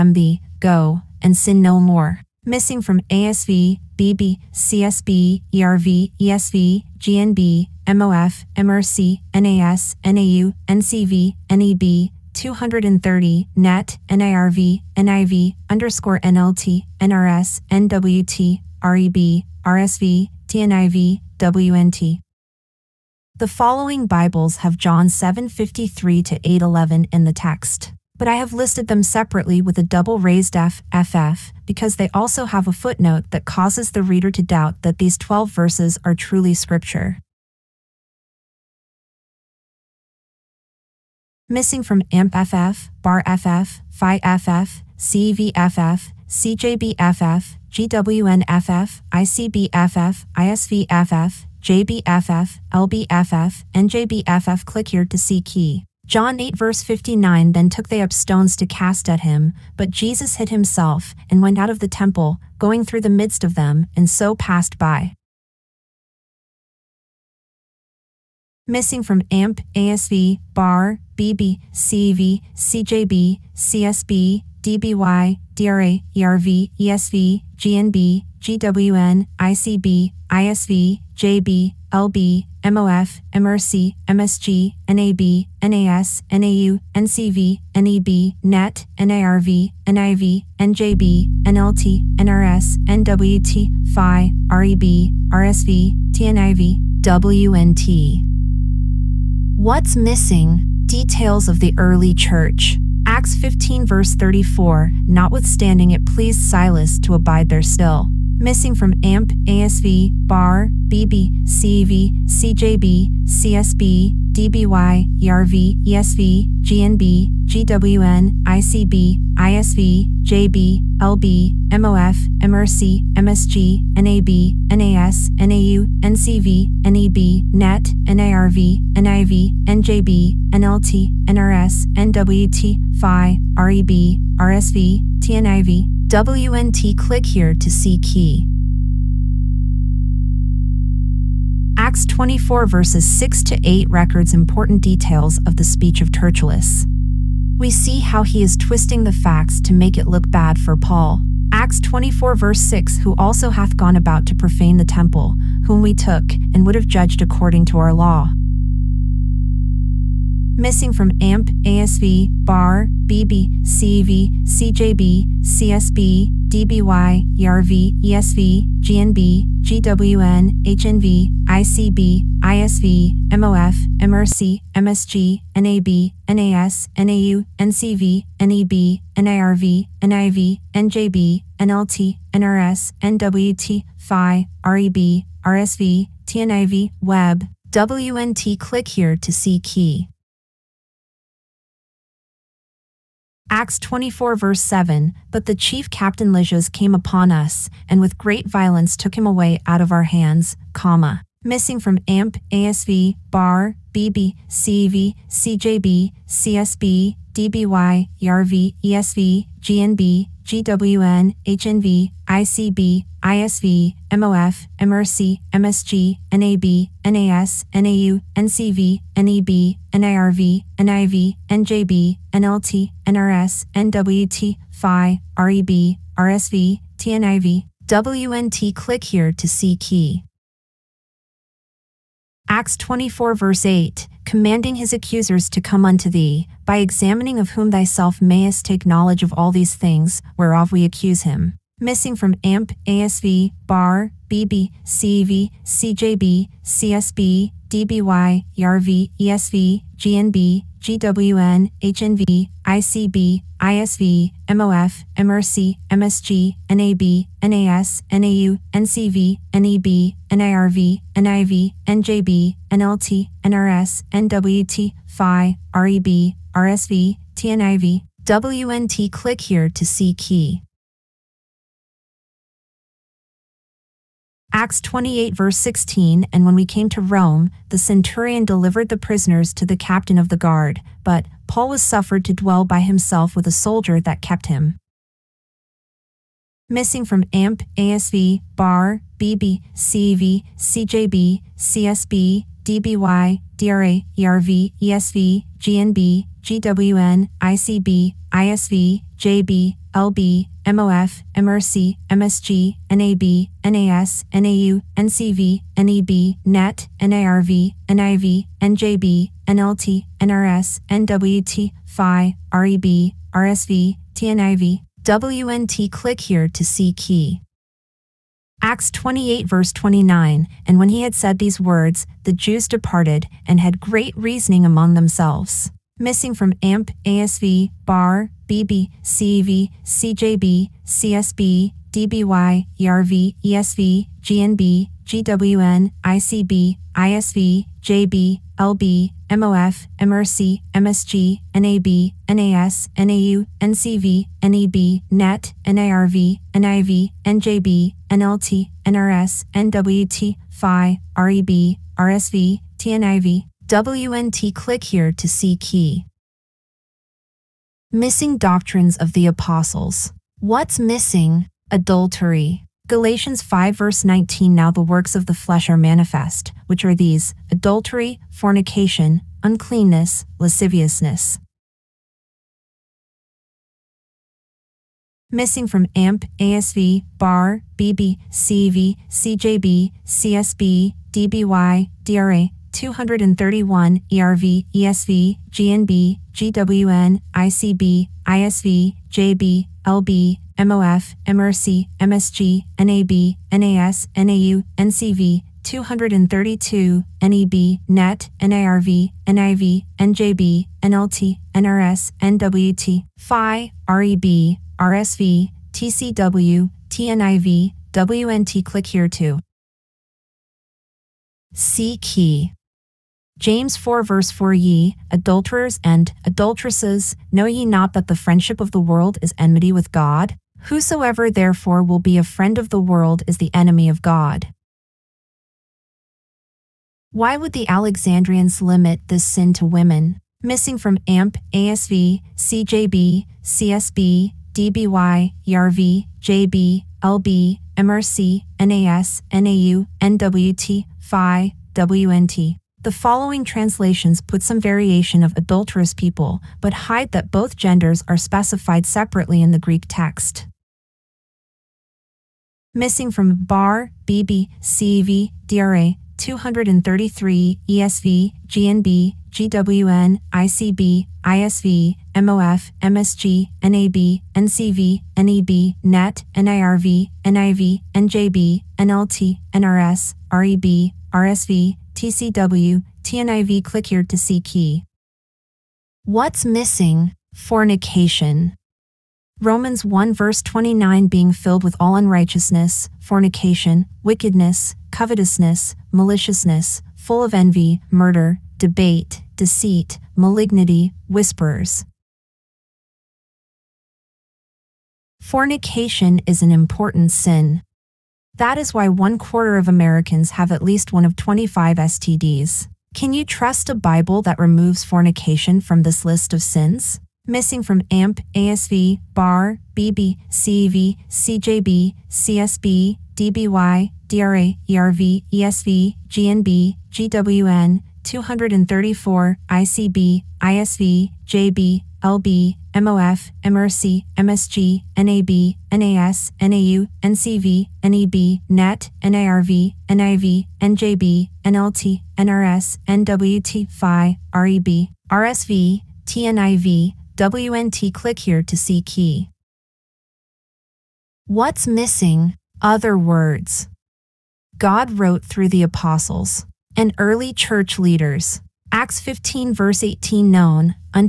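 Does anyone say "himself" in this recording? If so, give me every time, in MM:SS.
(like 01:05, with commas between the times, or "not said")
01:00, 04:42.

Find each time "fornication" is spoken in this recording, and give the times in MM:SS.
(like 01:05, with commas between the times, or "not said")
06:08, 07:57, 08:02, 08:15, 08:24.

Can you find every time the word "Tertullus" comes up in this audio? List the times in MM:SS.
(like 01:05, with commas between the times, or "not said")
02:26.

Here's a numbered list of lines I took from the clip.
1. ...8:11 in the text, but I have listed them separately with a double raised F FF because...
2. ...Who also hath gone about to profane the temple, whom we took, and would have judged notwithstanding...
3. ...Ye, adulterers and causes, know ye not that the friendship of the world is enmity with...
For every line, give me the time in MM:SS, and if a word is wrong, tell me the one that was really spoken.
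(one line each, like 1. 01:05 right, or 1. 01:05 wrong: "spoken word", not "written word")
1. 00:26 right
2. 02:32 wrong: "according", not "notwithstanding"
3. 06:54 wrong: "adulteresses", not "causes".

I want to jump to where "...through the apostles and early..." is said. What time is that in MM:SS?
09:05.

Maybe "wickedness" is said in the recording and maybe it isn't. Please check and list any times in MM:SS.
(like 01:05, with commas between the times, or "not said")
08:04.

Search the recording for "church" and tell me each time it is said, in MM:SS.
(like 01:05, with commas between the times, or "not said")
01:42, 09:07.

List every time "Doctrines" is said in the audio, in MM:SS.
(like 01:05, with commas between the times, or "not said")
05:58.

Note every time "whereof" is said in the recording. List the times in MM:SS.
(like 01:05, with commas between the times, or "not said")
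04:00.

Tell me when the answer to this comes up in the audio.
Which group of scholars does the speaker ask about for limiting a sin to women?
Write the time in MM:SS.
07:07.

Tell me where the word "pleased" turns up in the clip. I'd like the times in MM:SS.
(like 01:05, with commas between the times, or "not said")
01:46.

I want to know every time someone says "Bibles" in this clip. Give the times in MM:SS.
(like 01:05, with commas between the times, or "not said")
00:24, 08:23.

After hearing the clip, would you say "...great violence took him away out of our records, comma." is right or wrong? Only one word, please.
wrong.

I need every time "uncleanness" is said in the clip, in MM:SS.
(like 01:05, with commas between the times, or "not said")
06:09.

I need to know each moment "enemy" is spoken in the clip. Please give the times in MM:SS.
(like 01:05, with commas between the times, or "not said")
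07:03.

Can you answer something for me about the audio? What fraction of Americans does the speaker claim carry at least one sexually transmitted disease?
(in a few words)
one quarter.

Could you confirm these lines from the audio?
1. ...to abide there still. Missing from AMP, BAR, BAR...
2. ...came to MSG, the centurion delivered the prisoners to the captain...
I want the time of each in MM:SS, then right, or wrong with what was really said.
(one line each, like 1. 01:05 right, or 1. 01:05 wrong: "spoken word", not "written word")
1. 01:47 wrong: "ASV", not "BAR"
2. 04:36 wrong: "Rome", not "MSG".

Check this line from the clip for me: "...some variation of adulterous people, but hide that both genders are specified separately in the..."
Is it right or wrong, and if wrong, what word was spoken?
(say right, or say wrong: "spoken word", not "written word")
right.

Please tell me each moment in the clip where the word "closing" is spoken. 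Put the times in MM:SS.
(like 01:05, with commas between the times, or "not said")
not said.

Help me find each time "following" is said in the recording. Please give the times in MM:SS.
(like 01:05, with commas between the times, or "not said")
00:23, 07:22.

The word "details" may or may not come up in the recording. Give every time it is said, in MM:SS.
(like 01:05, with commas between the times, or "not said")
01:40, 02:24.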